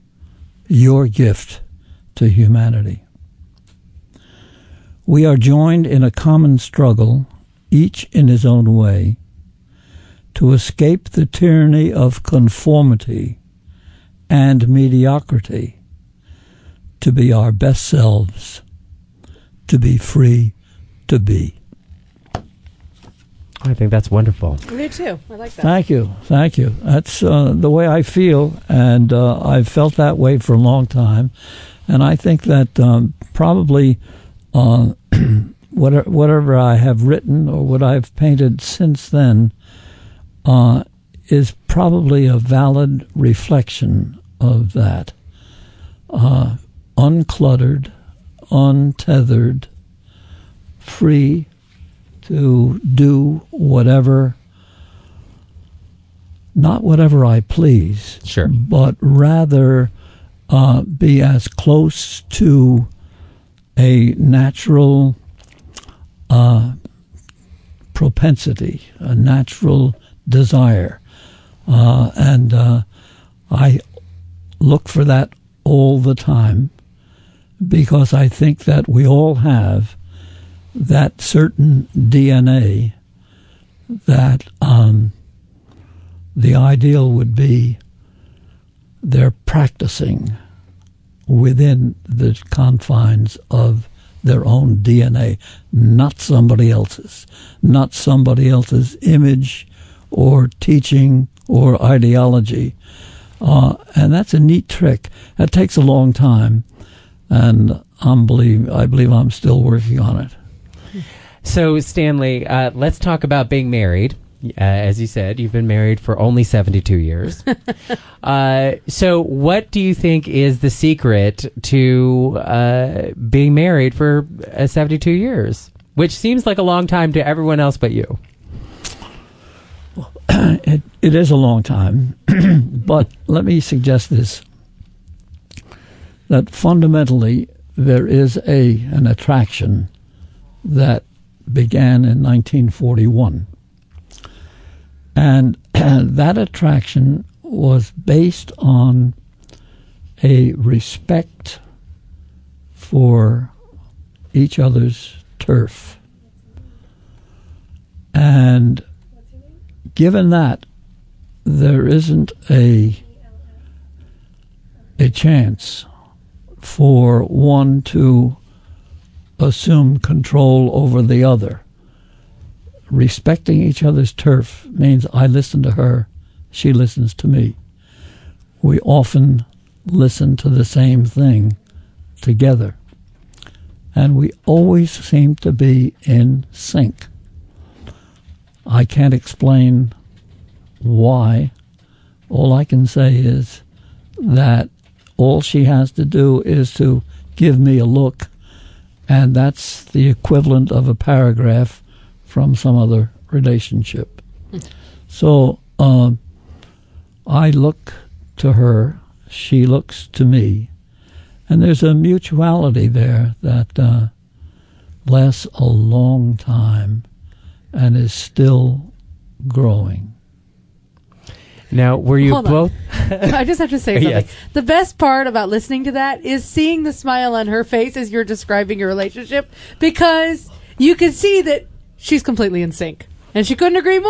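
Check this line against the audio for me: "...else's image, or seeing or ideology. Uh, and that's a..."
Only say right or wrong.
wrong.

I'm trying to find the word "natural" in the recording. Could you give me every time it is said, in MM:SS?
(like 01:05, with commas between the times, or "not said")
01:04, 01:09.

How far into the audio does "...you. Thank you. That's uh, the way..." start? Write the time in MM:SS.
00:25.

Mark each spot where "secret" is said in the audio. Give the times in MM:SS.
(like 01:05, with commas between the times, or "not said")
02:00.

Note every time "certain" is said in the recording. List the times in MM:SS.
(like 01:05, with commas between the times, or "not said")
01:21.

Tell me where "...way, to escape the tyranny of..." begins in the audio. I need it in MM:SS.
00:08.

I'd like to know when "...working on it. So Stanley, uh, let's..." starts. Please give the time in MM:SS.
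01:49.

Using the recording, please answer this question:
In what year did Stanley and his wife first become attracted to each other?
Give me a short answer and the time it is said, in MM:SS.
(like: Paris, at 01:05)
1941, at 02:22.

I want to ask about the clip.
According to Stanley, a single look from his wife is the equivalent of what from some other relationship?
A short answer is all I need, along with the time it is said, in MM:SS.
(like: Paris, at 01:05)
A paragraph, at 03:20.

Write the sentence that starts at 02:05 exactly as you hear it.
Which seems like a long time to everyone else but you.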